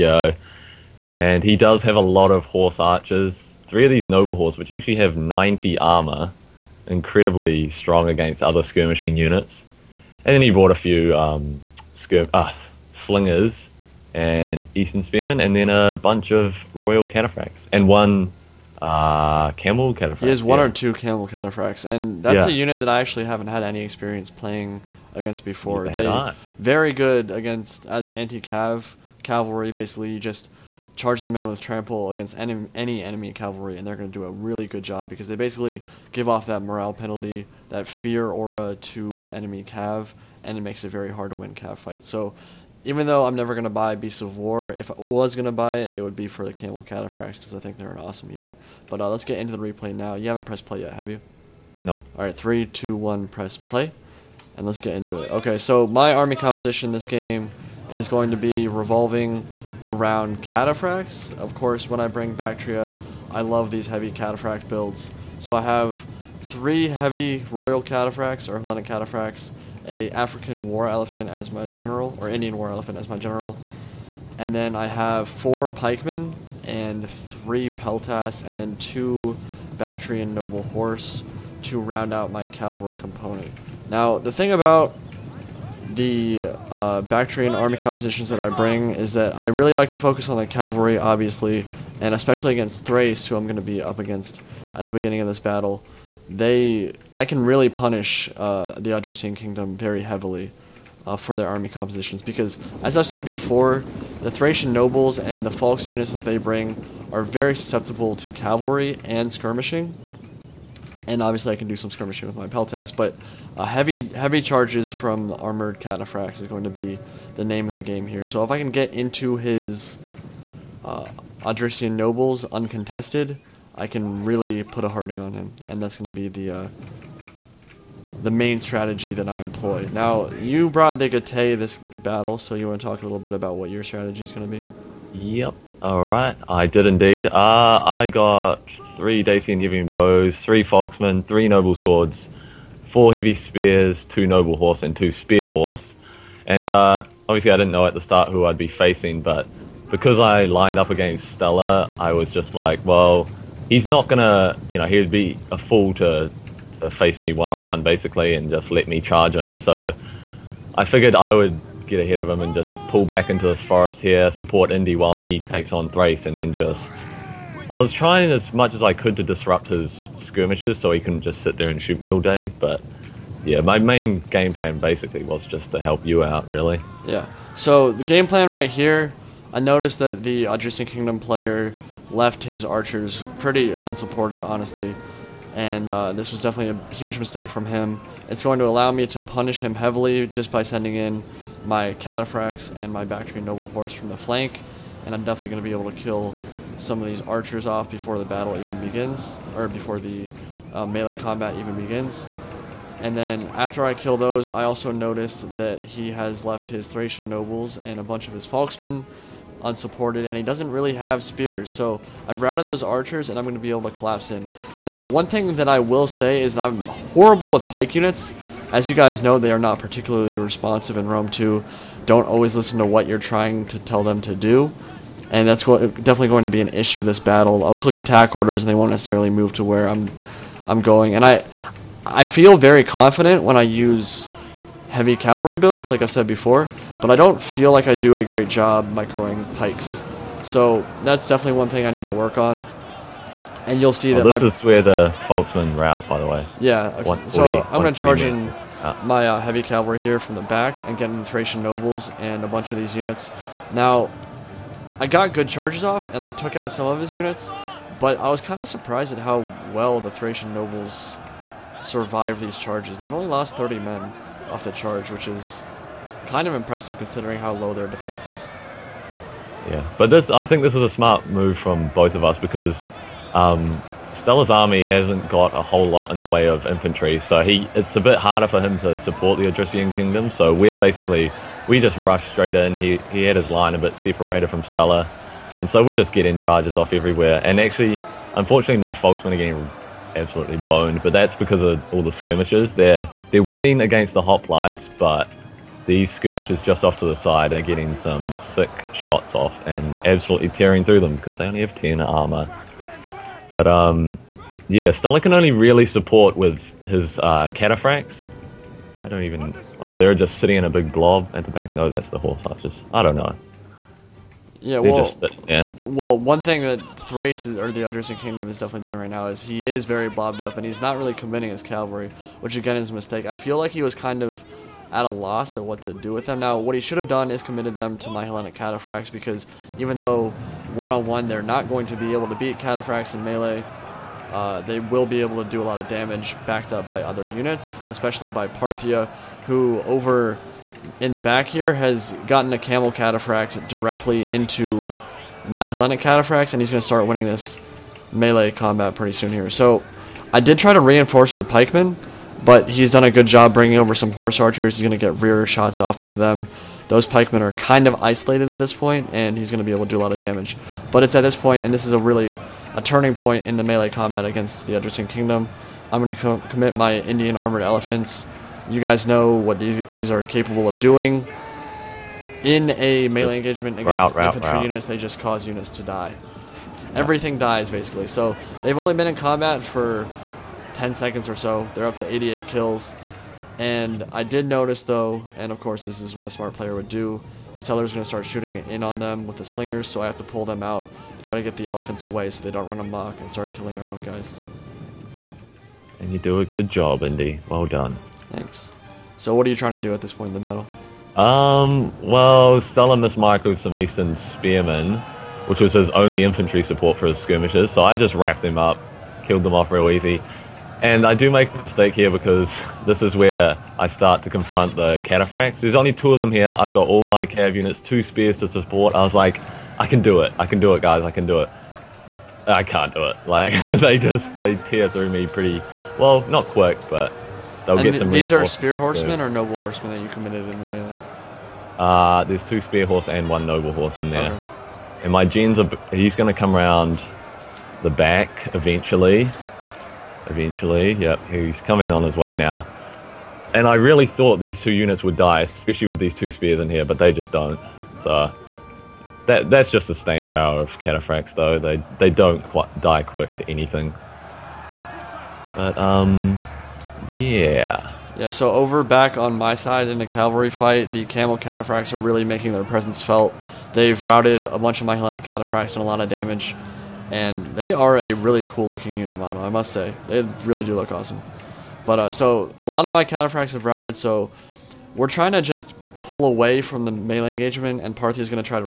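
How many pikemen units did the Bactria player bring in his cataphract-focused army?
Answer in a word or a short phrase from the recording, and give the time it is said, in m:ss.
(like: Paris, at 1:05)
4, at 1:15.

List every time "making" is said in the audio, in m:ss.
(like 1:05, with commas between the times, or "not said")
7:42.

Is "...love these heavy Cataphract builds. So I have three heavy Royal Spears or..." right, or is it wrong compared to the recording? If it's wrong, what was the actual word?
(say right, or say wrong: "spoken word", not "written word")
wrong: "Cataphracts", not "Spears".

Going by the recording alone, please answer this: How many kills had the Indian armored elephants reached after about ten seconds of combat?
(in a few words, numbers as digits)
88.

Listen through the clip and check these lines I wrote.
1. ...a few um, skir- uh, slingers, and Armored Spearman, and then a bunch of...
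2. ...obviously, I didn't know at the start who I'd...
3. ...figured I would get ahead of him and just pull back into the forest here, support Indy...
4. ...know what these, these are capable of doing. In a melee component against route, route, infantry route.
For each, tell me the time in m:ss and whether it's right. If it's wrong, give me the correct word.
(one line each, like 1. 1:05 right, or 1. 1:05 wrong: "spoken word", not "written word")
1. 0:10 wrong: "Eastern", not "Armored"
2. 2:27 right
3. 2:40 right
4. 6:09 wrong: "engagement", not "component".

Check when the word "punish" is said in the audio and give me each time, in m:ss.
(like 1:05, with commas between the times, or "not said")
1:37, 3:09.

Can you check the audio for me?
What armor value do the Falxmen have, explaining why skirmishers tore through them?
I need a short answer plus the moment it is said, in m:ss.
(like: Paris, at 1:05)
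10, at 5:01.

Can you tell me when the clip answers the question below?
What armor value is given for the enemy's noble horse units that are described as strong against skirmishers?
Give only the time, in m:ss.
0:05.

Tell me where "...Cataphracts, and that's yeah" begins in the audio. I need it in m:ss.
0:21.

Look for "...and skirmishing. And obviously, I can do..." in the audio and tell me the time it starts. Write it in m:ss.
1:49.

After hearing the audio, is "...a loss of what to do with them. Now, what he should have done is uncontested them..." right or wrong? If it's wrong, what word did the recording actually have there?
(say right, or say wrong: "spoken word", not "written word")
wrong: "committed", not "uncontested".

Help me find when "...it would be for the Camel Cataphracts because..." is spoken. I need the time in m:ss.
0:45.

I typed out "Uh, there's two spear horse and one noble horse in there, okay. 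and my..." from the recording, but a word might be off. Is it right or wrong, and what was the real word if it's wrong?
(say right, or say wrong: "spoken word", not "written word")
right.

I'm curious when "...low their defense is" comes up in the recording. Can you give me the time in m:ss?
4:27.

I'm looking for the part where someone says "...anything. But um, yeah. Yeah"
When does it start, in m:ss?
7:33.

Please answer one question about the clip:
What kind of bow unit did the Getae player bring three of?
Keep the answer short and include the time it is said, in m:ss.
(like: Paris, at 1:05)
Dacian Giving Bows, at 2:19.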